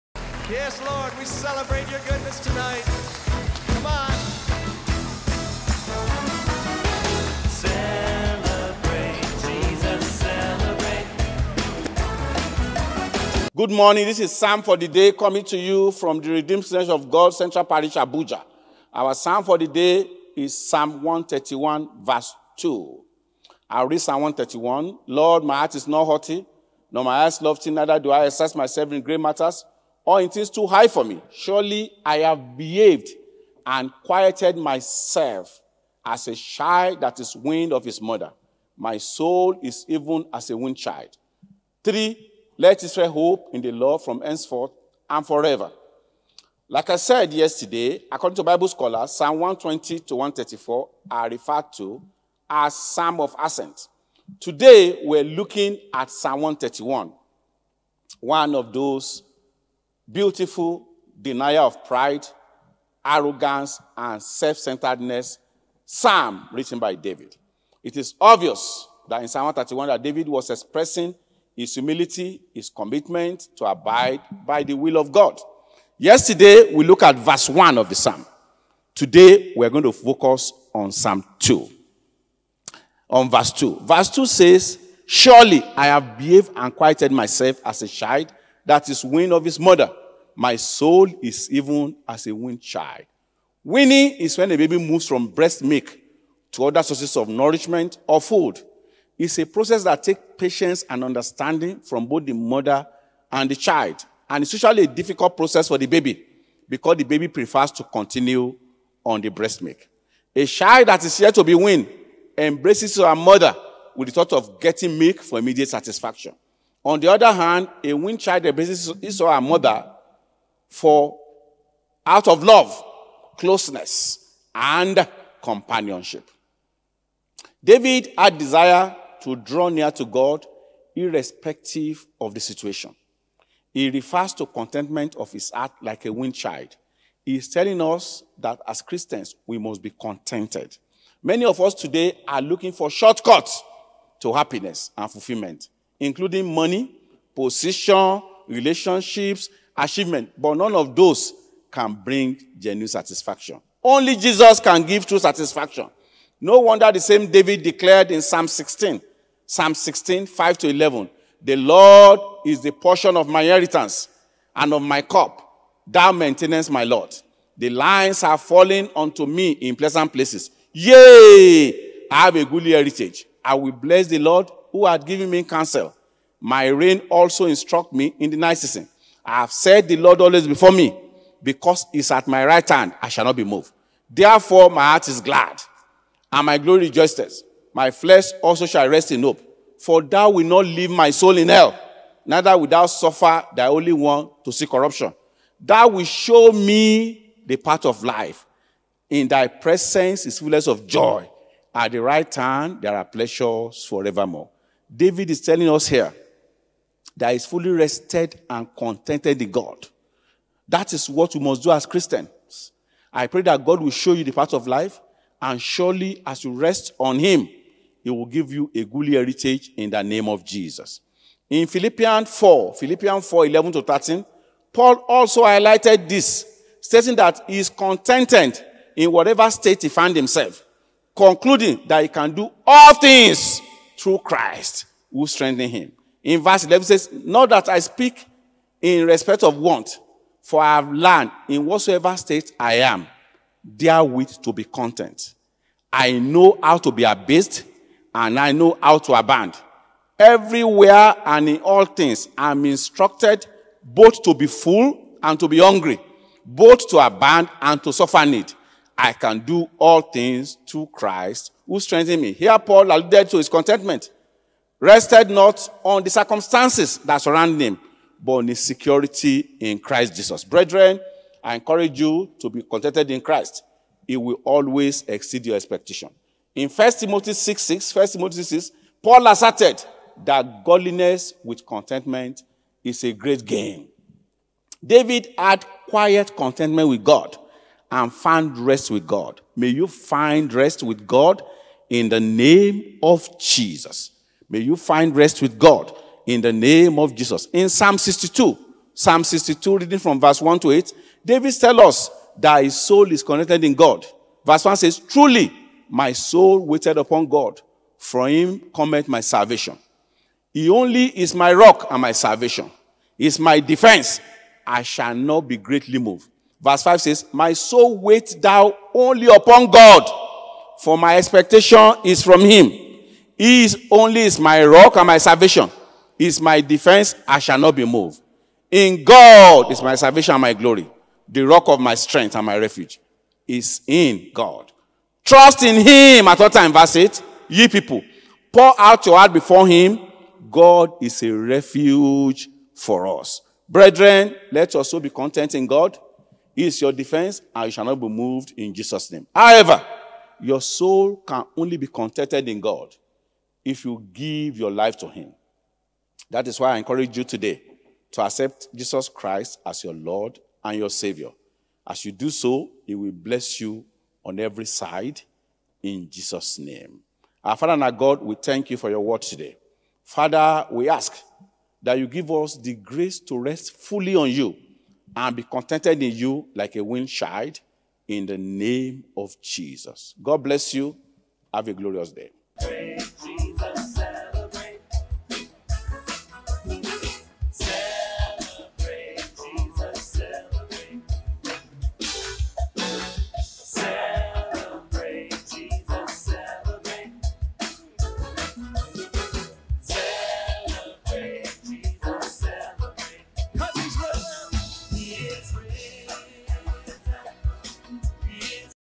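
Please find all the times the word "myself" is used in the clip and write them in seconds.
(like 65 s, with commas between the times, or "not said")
28 s, 34 s, 87 s.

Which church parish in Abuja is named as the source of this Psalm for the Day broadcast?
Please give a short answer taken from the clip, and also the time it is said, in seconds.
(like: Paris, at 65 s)
Central Parish, at 17 s.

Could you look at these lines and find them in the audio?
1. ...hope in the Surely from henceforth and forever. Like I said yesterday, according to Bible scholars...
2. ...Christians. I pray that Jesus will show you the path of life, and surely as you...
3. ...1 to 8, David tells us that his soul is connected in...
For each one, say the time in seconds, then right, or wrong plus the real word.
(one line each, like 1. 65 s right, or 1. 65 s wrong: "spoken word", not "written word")
1. 43 s wrong: "Lord", not "Surely"
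2. 211 s wrong: "God", not "Jesus"
3. 300 s right.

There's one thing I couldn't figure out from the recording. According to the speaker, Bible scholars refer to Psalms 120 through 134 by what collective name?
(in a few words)
Psalm of Ascent.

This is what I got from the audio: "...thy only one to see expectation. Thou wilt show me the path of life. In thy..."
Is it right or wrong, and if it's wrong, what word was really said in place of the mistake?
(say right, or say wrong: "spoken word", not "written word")
wrong: "corruption", not "expectation".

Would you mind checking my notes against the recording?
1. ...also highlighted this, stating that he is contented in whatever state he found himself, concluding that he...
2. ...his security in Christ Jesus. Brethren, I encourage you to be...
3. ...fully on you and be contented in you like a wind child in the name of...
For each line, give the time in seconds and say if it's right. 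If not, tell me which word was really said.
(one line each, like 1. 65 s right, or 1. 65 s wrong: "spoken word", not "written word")
1. 225 s right
2. 268 s right
3. 373 s right.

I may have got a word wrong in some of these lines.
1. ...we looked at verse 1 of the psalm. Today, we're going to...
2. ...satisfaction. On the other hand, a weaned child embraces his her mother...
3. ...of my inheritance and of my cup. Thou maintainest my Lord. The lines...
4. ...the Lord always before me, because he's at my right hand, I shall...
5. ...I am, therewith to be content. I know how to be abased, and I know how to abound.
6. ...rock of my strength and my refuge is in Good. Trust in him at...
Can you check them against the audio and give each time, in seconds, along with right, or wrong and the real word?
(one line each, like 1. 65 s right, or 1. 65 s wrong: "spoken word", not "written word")
1. 76 s right
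2. 115 s right
3. 163 s right
4. 179 s right
5. 242 s right
6. 331 s wrong: "God", not "Good".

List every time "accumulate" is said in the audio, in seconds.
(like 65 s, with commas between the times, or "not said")
not said.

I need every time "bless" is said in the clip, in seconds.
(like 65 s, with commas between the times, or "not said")
173 s, 363 s, 380 s.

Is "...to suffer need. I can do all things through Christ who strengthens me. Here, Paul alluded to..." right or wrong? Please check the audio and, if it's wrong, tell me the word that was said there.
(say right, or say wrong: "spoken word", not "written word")
right.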